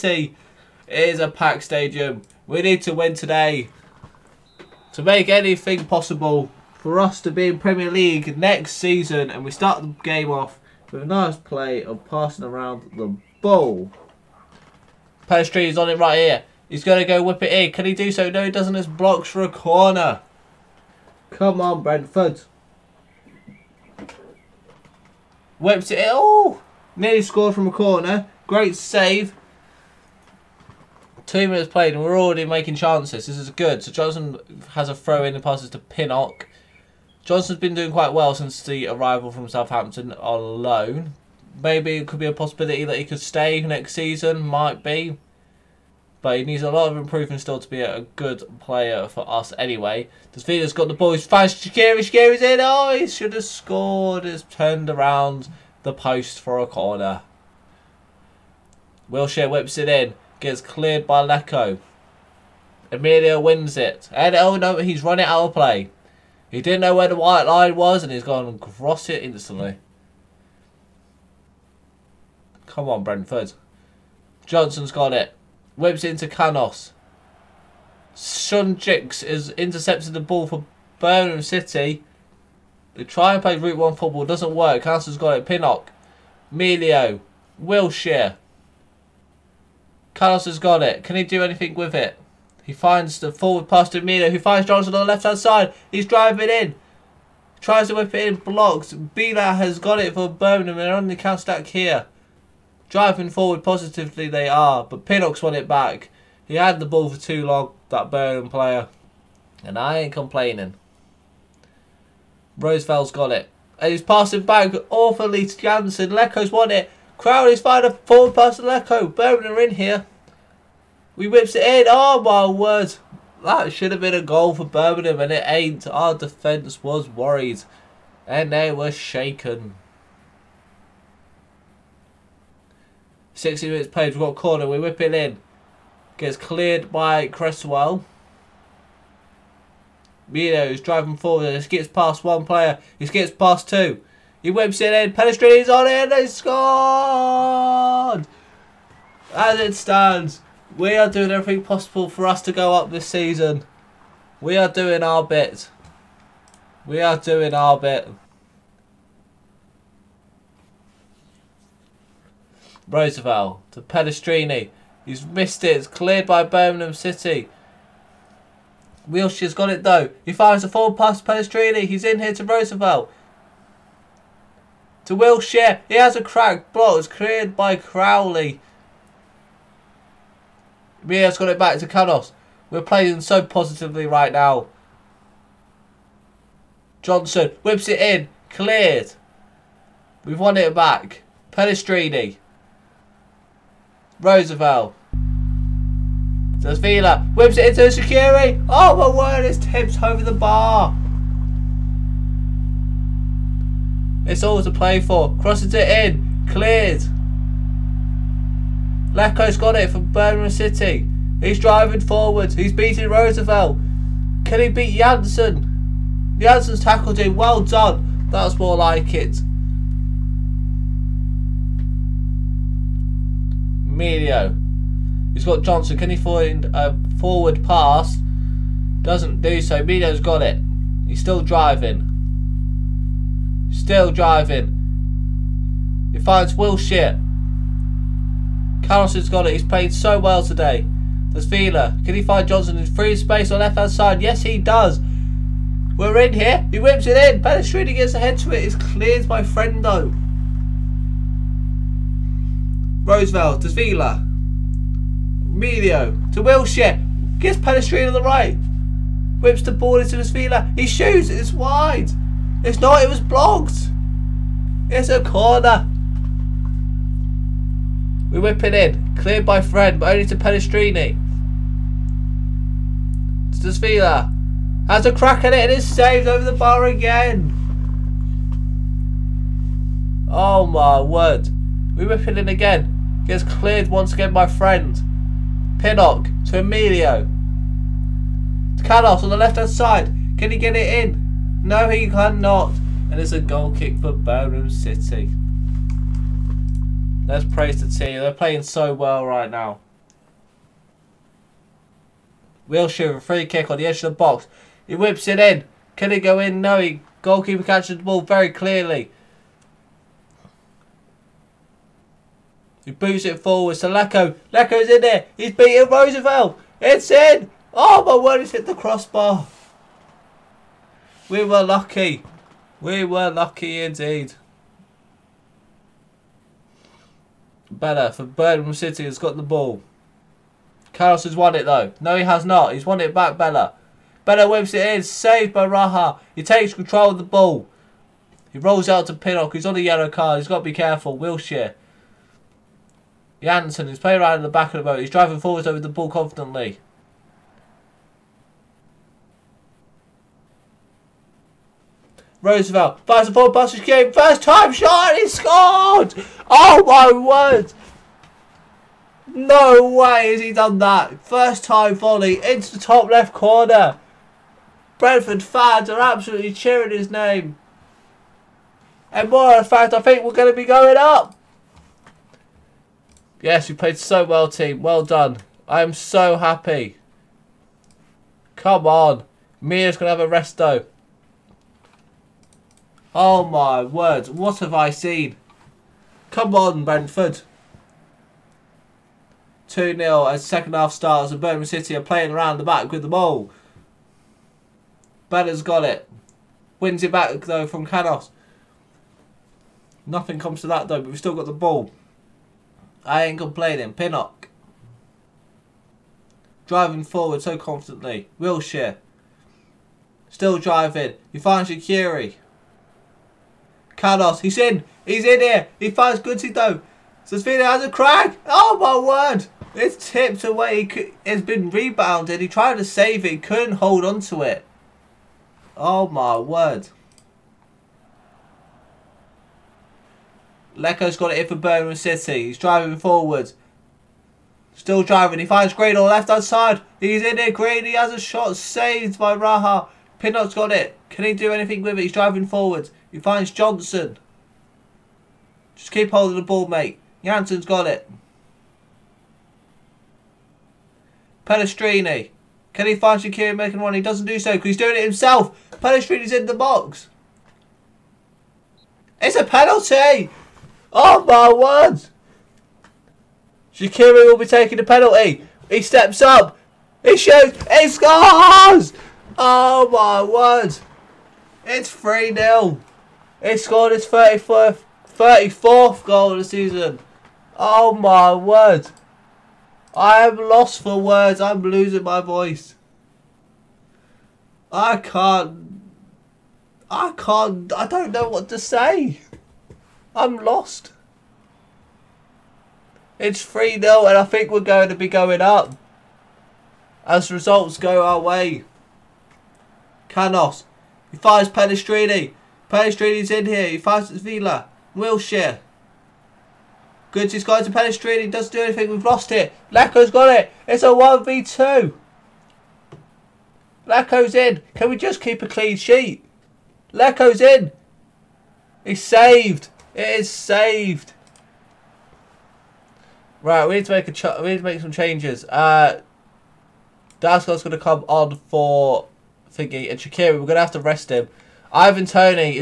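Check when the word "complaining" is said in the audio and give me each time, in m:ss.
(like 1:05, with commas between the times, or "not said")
1:50, 6:43.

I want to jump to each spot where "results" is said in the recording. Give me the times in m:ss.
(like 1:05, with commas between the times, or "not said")
8:17.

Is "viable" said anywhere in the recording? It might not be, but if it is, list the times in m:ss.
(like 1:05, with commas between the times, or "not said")
not said.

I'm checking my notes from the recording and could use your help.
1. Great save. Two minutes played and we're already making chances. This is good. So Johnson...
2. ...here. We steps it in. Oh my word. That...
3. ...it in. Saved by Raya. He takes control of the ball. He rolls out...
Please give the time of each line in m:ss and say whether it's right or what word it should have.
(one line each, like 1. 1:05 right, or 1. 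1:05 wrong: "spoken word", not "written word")
1. 0:28 right
2. 1:59 wrong: "whips", not "steps"
3. 5:34 right.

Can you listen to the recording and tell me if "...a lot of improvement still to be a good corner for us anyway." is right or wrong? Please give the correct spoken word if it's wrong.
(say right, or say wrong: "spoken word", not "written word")
wrong: "player", not "corner".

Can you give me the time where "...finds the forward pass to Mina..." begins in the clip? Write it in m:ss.
1:32.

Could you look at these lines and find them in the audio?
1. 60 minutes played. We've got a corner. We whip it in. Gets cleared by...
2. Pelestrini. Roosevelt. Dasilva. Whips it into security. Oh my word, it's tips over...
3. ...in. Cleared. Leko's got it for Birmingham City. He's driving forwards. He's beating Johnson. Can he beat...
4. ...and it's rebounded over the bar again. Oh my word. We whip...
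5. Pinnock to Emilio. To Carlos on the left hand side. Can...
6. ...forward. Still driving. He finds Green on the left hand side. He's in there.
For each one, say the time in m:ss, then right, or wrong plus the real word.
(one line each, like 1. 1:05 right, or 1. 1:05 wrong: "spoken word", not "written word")
1. 2:13 right
2. 3:11 right
3. 3:25 wrong: "Roosevelt", not "Johnson"
4. 4:35 wrong: "saved", not "rebounded"
5. 4:45 right
6. 7:12 right.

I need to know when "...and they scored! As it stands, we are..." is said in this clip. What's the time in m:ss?
2:25.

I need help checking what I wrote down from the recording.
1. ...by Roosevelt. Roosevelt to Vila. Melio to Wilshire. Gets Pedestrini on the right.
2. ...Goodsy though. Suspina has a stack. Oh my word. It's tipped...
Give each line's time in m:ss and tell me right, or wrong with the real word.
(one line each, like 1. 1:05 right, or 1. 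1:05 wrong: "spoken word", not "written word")
1. 4:09 wrong: "Frendo", not "Roosevelt"
2. 6:56 wrong: "crack", not "stack".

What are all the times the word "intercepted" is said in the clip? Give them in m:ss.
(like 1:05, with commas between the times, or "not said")
1:19.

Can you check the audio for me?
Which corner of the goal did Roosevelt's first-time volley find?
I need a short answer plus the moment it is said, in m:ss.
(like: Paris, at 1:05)
Top left corner, at 6:02.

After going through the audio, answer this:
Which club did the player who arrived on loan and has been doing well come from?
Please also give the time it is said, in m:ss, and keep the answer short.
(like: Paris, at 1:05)
Southampton, at 0:39.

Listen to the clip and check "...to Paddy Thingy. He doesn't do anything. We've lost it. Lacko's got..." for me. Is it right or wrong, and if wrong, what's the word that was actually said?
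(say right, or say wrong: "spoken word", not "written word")
wrong: "Street", not "Thingy".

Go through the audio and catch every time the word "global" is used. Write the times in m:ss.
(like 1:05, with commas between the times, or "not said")
not said.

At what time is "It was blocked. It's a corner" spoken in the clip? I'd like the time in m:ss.
4:23.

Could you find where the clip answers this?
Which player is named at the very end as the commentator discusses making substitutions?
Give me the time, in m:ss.
8:51.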